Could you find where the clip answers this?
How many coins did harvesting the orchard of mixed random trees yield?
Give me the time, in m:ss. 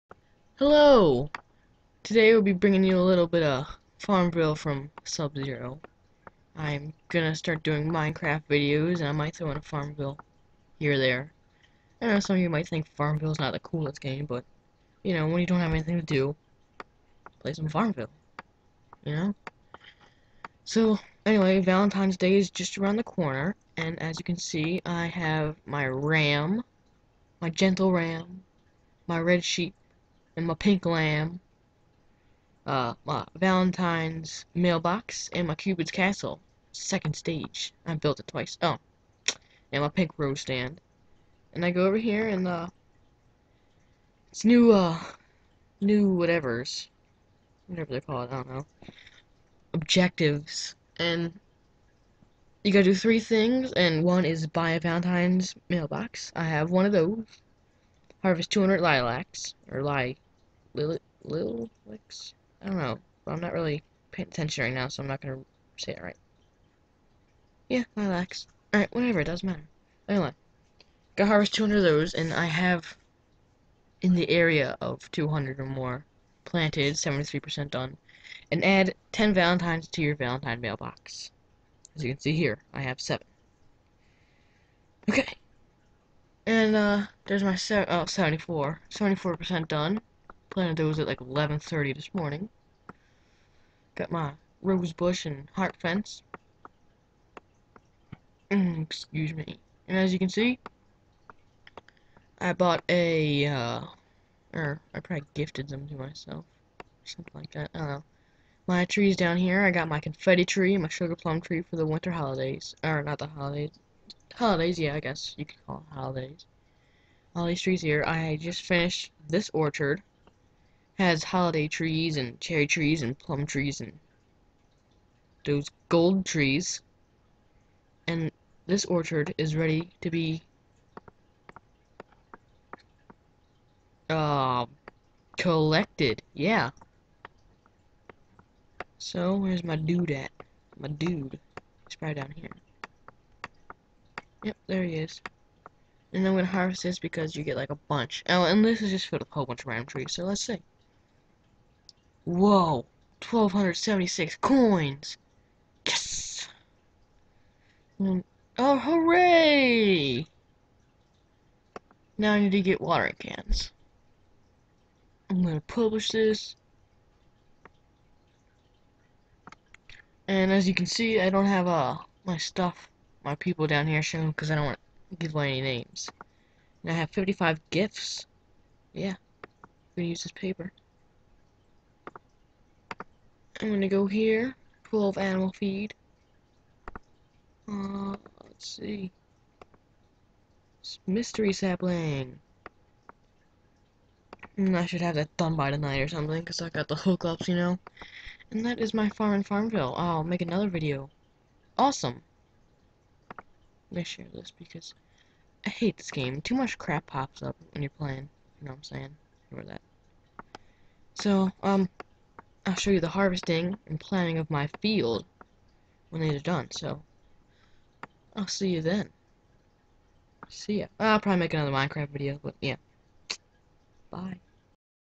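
2:33.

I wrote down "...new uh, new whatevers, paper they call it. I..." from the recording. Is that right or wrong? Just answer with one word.
wrong.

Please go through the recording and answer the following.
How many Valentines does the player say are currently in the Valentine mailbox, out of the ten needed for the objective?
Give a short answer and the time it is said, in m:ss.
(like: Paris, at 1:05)
7, at 1:22.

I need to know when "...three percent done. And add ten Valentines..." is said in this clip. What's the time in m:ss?
1:17.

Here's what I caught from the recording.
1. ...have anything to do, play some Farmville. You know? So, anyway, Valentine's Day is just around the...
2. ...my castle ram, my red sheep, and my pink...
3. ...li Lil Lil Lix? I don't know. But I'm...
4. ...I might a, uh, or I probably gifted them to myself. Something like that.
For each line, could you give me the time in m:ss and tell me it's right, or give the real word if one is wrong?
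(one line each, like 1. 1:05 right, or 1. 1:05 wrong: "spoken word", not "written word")
1. 0:15 right
2. 0:27 wrong: "gentle", not "castle"
3. 0:59 right
4. 1:42 wrong: "bought", not "might".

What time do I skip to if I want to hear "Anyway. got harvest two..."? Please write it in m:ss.
1:10.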